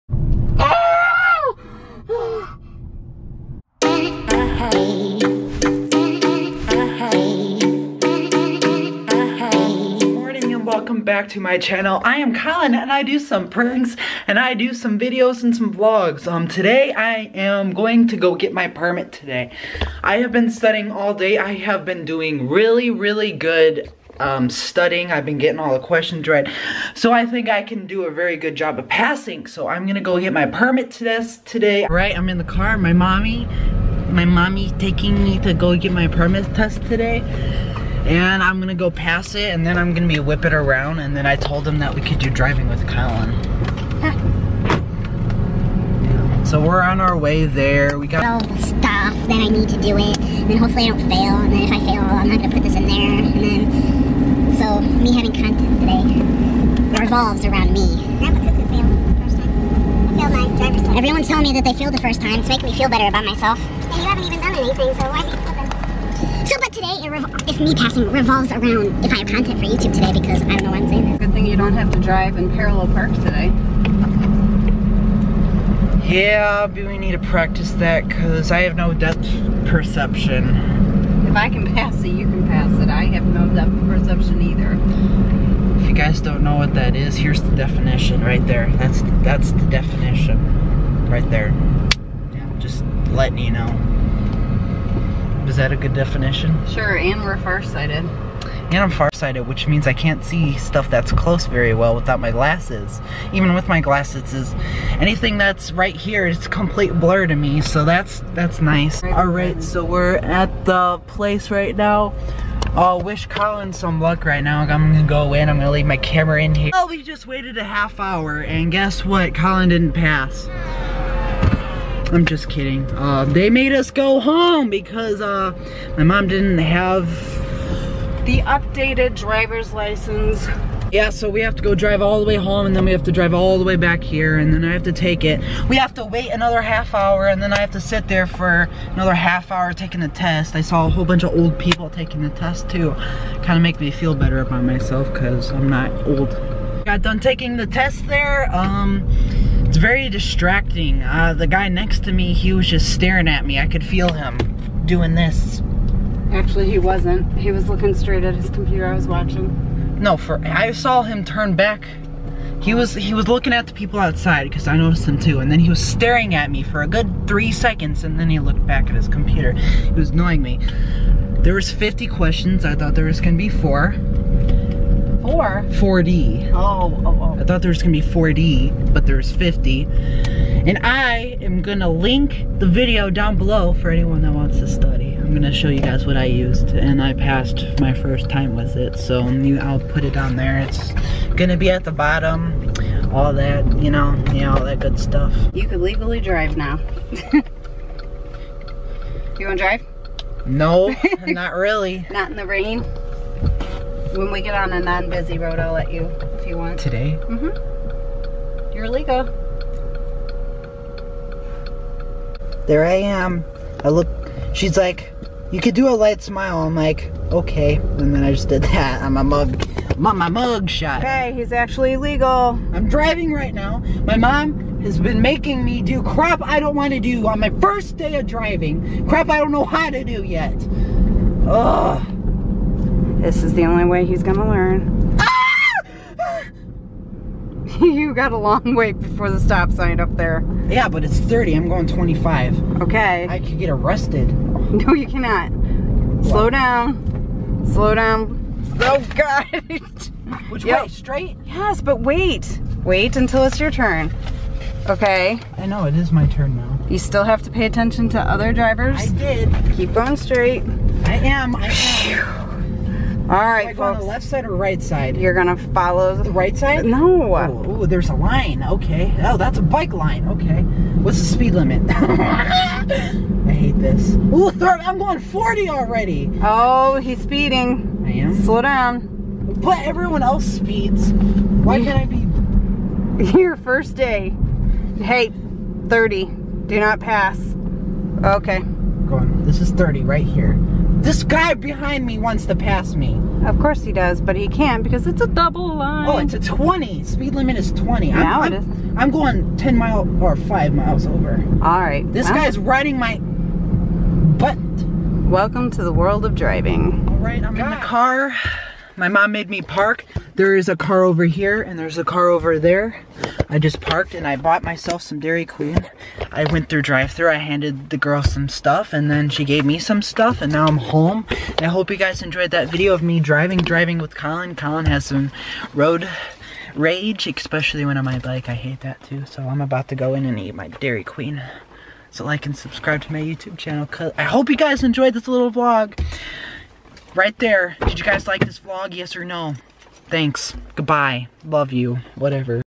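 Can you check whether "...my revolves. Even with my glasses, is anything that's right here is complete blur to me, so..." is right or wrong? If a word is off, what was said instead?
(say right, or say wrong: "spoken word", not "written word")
wrong: "glasses", not "revolves".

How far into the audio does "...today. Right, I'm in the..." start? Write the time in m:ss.
0:31.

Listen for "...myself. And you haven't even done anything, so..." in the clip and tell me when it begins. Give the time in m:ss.
1:03.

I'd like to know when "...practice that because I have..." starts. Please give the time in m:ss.
1:17.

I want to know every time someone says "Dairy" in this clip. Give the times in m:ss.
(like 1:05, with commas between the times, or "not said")
5:15, 5:30.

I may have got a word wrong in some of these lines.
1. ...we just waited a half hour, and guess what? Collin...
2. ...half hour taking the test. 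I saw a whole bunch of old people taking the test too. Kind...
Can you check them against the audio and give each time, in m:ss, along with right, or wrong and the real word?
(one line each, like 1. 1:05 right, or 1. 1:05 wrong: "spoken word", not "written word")
1. 1:56 right
2. 2:19 right.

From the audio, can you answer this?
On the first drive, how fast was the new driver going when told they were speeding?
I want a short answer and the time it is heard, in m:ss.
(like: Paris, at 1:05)
40, at 4:35.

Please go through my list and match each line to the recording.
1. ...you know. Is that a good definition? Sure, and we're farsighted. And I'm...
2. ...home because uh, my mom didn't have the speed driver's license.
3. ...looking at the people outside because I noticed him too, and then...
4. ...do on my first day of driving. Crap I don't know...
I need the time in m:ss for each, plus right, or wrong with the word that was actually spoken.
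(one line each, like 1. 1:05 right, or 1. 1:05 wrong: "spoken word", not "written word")
1. 1:33 right
2. 2:04 wrong: "updated", not "speed"
3. 2:43 right
4. 3:46 right.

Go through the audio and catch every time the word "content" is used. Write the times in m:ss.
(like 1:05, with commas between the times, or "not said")
0:55, 1:09.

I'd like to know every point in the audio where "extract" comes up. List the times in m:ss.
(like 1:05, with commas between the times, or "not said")
not said.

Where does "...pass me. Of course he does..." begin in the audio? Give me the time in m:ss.
4:52.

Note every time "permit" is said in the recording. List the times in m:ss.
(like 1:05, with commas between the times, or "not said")
0:18, 0:30, 0:36.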